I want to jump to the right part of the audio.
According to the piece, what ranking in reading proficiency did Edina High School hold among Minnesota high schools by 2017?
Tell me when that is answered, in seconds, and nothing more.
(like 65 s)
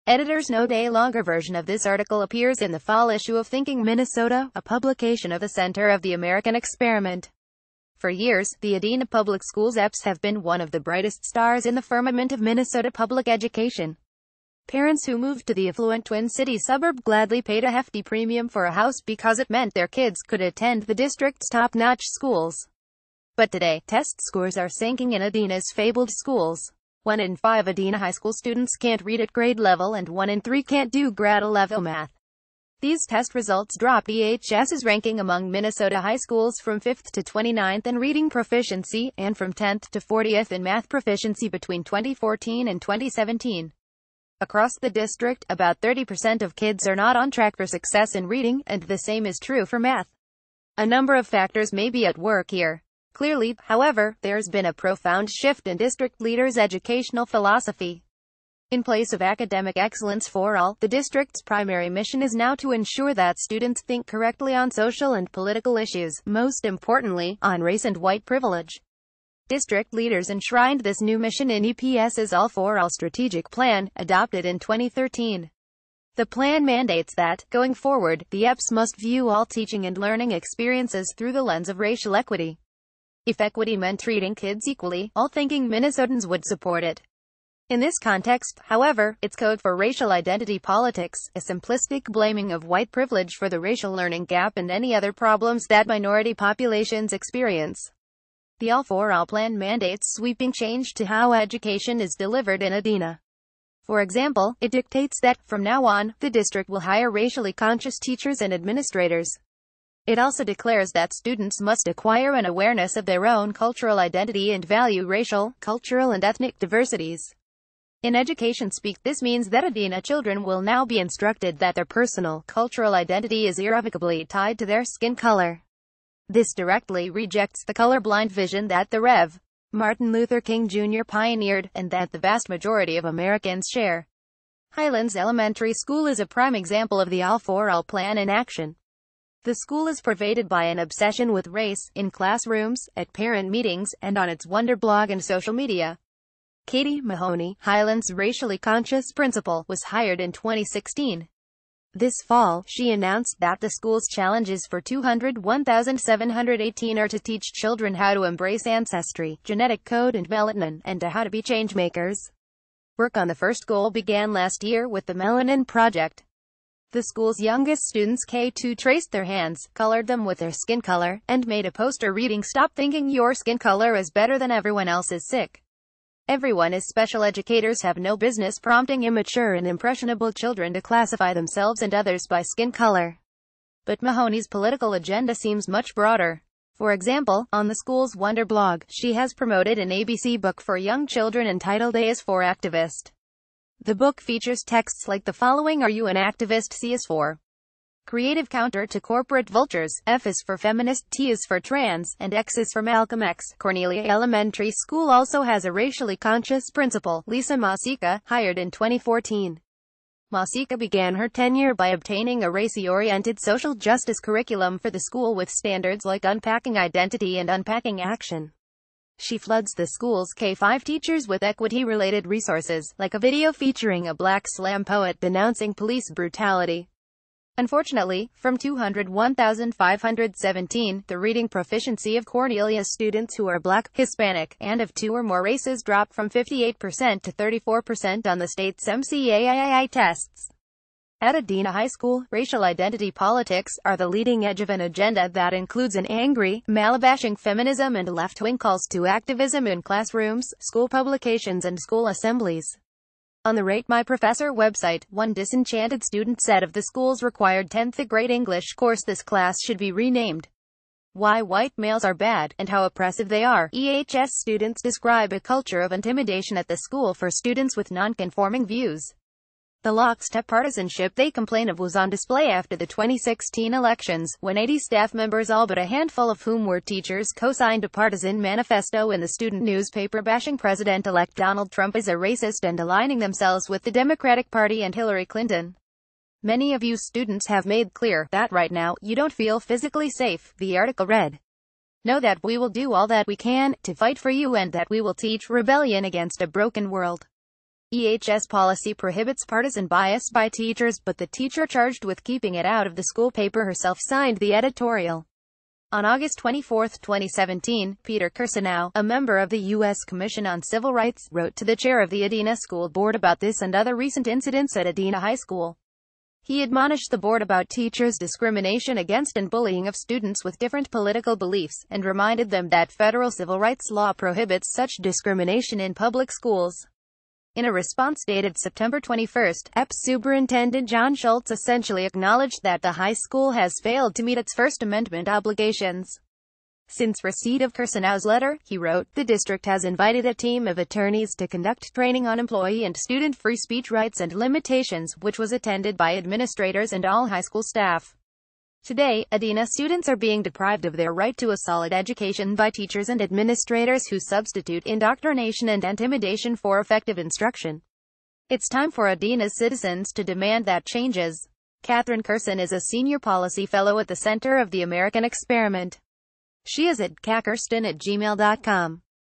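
37 s.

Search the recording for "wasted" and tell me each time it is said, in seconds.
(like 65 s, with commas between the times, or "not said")
not said.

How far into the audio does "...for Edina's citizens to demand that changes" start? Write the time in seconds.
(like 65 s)
358 s.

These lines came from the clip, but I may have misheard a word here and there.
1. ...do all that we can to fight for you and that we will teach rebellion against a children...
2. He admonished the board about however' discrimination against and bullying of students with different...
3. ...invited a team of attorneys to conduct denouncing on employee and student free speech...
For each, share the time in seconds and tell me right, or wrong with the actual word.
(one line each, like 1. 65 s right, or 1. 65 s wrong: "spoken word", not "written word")
1. 292 s wrong: "broken", not "children"
2. 316 s wrong: "teachers", not "however"
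3. 339 s wrong: "training", not "denouncing".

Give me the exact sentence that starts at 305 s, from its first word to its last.
On August 24, 2017, Peter Kirsanow, a member of the U.S.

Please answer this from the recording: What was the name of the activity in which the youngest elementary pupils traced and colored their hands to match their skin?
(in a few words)
Melanin Project.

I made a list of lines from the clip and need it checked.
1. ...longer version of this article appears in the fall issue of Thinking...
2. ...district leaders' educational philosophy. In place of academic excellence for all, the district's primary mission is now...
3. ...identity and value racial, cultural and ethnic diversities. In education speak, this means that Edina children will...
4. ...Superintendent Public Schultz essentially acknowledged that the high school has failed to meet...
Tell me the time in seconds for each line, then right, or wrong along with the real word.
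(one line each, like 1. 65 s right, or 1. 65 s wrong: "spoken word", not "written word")
1. 0 s right
2. 55 s right
3. 113 s right
4. 329 s wrong: "John", not "Public".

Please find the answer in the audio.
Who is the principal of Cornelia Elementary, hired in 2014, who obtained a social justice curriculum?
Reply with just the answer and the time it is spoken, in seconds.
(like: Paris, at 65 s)
Lisa Masika, at 207 s.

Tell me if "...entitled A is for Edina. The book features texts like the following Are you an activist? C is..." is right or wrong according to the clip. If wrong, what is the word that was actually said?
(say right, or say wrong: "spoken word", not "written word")
wrong: "Activist", not "Edina".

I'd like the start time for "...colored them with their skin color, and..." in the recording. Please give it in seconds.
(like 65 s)
169 s.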